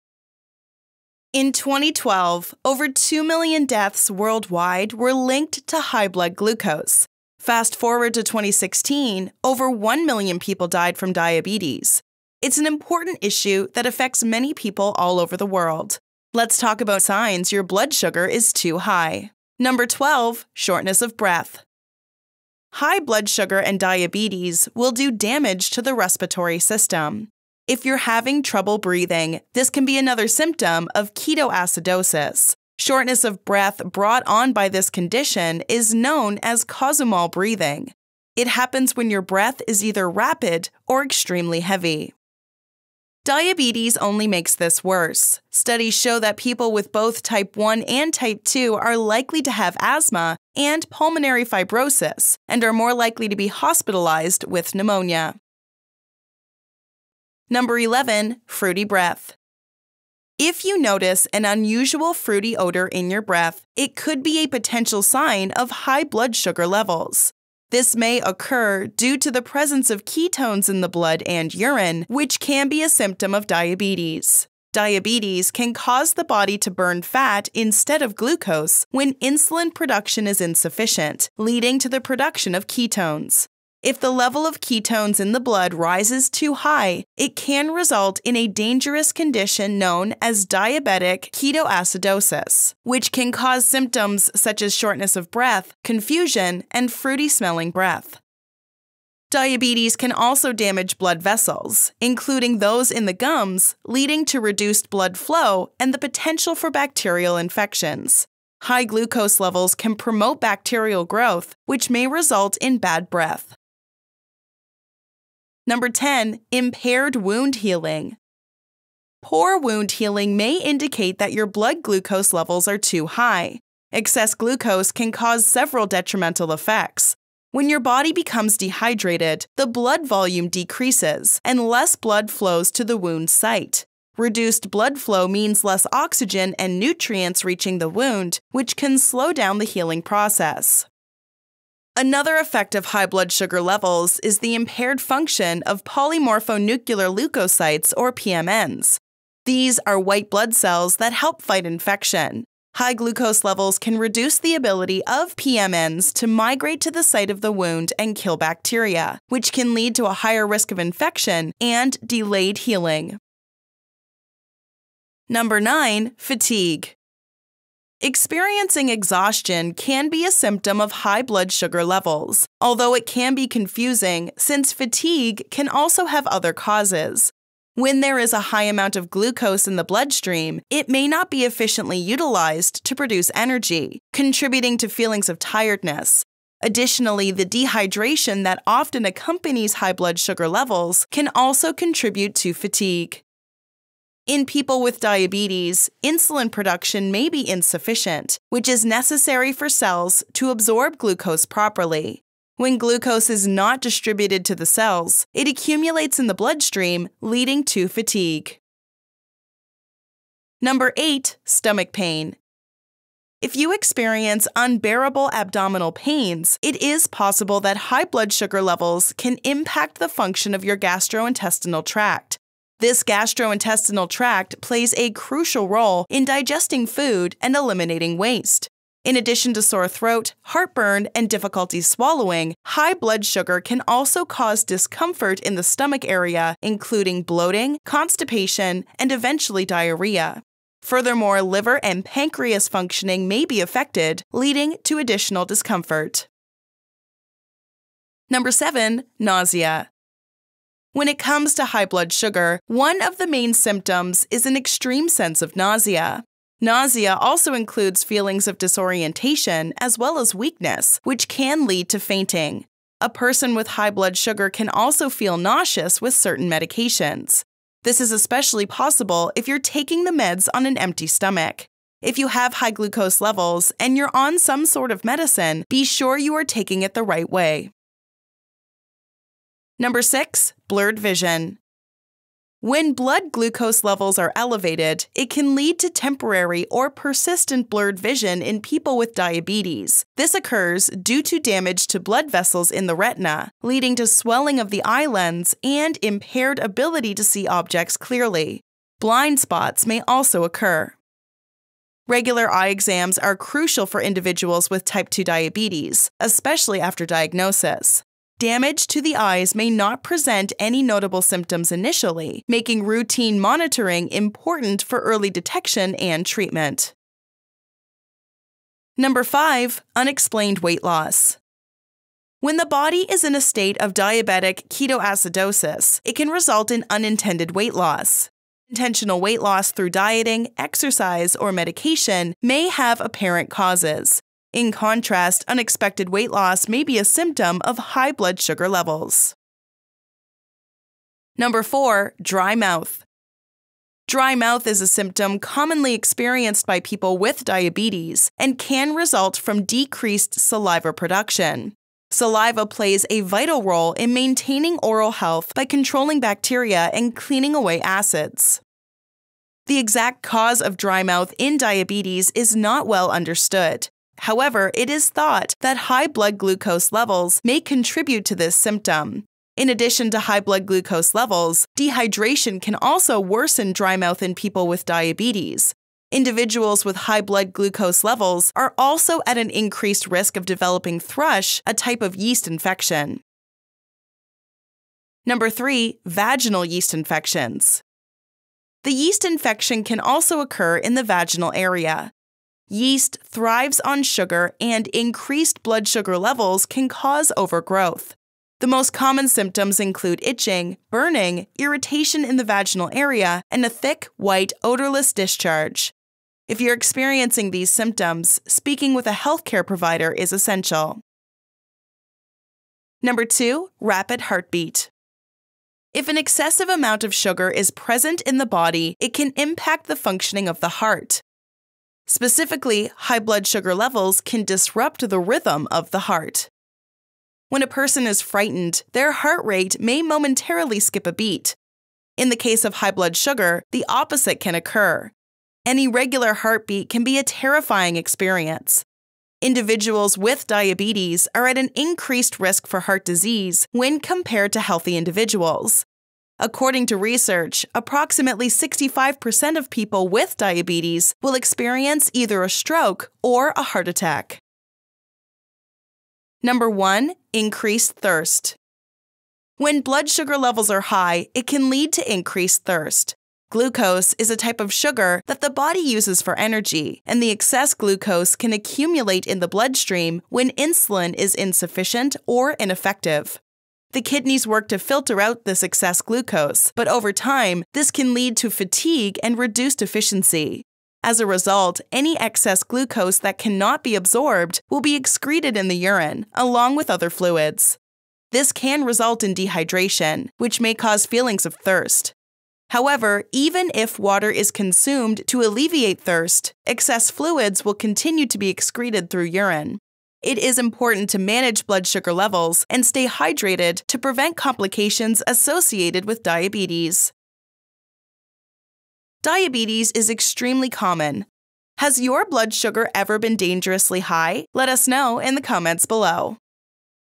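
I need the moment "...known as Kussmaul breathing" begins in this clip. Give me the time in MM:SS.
00:35.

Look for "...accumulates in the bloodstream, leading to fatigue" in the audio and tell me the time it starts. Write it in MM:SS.
03:25.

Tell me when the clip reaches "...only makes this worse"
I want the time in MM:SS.
00:43.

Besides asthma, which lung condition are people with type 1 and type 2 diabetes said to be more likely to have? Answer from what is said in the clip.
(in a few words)
pulmonary fibrosis.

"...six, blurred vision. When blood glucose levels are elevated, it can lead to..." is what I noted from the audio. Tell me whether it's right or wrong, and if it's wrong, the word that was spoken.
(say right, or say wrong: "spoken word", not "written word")
right.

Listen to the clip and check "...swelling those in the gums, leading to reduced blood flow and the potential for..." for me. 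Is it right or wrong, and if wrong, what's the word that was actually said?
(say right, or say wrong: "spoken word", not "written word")
wrong: "including", not "swelling".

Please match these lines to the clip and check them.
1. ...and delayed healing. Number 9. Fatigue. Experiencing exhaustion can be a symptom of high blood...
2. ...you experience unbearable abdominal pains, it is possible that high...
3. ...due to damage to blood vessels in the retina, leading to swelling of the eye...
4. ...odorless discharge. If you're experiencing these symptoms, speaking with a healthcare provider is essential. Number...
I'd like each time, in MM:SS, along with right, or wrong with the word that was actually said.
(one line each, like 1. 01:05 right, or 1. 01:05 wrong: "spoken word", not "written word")
1. 02:41 right
2. 03:33 right
3. 04:51 right
4. 06:44 right.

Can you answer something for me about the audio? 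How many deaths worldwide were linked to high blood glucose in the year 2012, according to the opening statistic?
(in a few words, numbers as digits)
over 2 million.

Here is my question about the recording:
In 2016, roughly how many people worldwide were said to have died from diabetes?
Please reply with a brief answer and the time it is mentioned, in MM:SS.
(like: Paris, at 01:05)
over 1 million, at 00:09.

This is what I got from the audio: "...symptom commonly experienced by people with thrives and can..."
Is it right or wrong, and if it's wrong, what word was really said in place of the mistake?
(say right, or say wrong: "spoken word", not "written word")
wrong: "diabetes", not "thrives".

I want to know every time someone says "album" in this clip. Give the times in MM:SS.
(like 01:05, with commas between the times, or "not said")
not said.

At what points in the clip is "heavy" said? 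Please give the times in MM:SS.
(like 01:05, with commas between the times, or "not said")
00:41.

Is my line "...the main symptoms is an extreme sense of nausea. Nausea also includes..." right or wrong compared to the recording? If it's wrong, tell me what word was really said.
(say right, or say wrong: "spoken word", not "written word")
right.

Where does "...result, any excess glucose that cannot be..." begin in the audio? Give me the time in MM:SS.
08:01.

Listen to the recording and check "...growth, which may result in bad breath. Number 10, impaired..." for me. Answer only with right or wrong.
right.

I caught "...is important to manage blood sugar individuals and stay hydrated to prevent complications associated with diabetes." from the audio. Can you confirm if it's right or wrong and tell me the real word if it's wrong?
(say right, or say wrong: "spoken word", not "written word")
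wrong: "levels", not "individuals".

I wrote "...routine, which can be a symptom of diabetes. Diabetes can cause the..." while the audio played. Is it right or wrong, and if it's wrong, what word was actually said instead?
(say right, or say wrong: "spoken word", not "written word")
wrong: "urine", not "routine".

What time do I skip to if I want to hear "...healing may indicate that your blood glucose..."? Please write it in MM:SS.
01:59.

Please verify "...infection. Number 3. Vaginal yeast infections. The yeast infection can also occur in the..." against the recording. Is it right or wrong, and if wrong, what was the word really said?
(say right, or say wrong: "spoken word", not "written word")
right.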